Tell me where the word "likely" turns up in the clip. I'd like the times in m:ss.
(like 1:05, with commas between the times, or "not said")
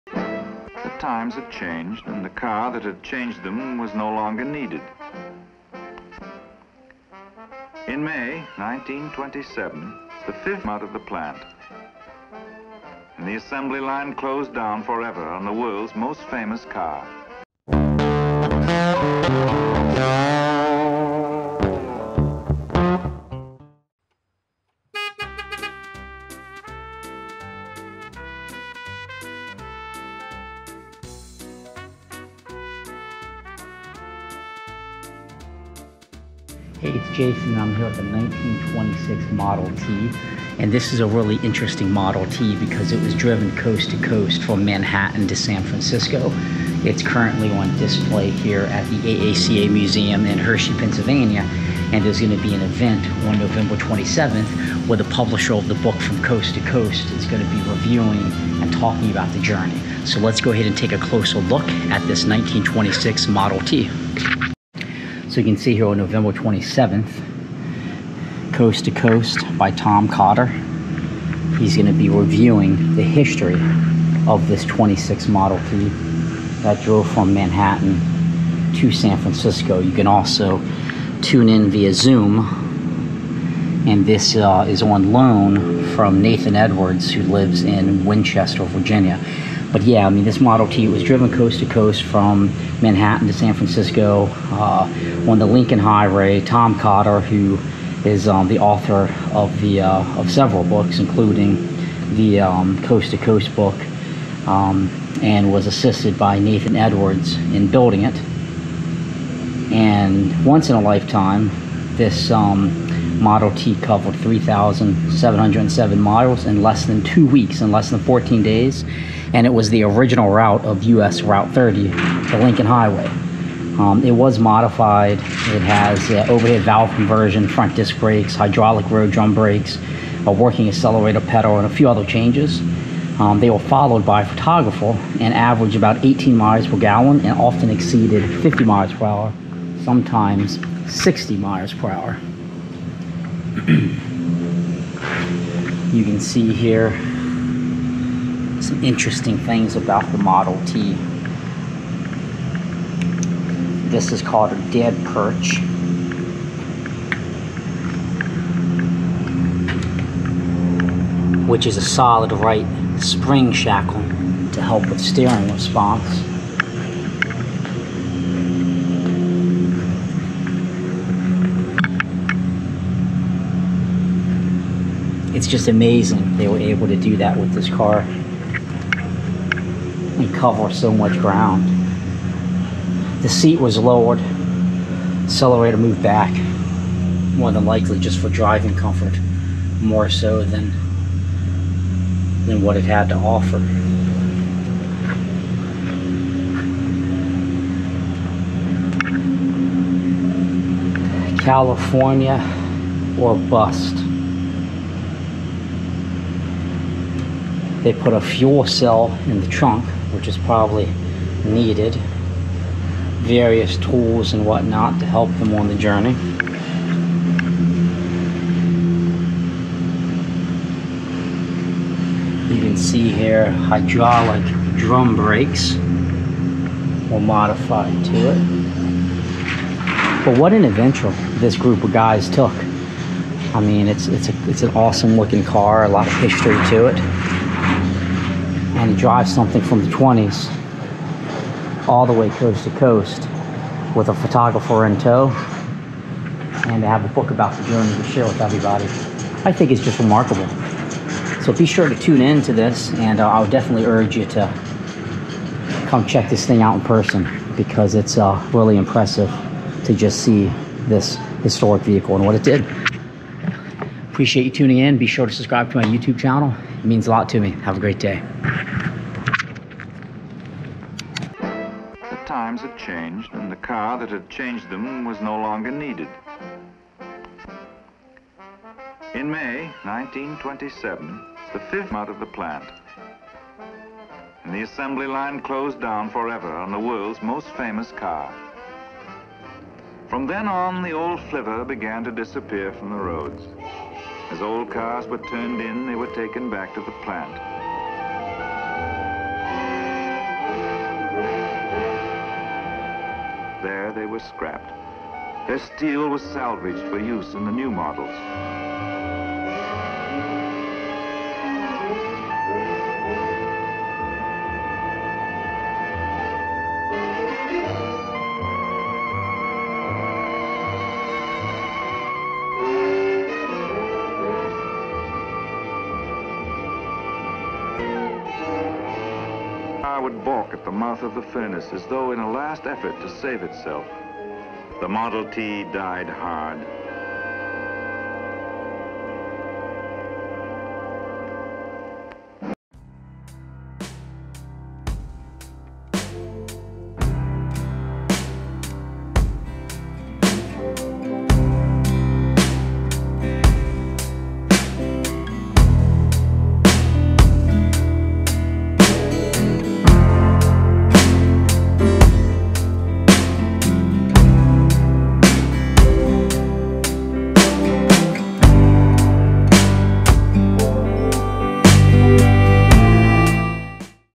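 3:07.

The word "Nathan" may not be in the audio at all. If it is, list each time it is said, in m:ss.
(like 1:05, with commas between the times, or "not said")
1:26, 1:46.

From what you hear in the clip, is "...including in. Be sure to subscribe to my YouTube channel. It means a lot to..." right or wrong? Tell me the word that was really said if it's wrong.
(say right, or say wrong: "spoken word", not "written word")
wrong: "tuning", not "including".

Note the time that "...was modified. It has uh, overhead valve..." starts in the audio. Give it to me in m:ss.
2:04.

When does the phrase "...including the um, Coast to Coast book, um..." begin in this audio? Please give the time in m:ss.
1:40.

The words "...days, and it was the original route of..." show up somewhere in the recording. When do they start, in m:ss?
1:58.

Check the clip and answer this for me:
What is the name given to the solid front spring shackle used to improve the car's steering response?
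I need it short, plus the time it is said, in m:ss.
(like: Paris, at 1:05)
dead perch, at 2:34.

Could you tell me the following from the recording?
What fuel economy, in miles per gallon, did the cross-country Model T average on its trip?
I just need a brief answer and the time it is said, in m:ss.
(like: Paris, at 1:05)
18, at 2:16.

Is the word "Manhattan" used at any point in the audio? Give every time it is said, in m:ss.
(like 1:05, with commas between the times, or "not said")
0:44, 1:17, 1:32.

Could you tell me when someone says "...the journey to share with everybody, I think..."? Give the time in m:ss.
4:07.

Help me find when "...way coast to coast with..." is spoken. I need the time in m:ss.
4:02.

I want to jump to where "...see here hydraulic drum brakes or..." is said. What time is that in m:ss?
3:42.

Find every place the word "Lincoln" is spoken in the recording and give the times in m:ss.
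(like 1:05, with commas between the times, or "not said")
1:35, 2:02.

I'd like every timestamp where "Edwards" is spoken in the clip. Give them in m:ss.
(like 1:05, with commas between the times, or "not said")
1:26, 1:46.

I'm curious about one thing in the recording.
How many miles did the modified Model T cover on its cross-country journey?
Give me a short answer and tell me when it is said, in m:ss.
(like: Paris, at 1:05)
3,707, at 1:54.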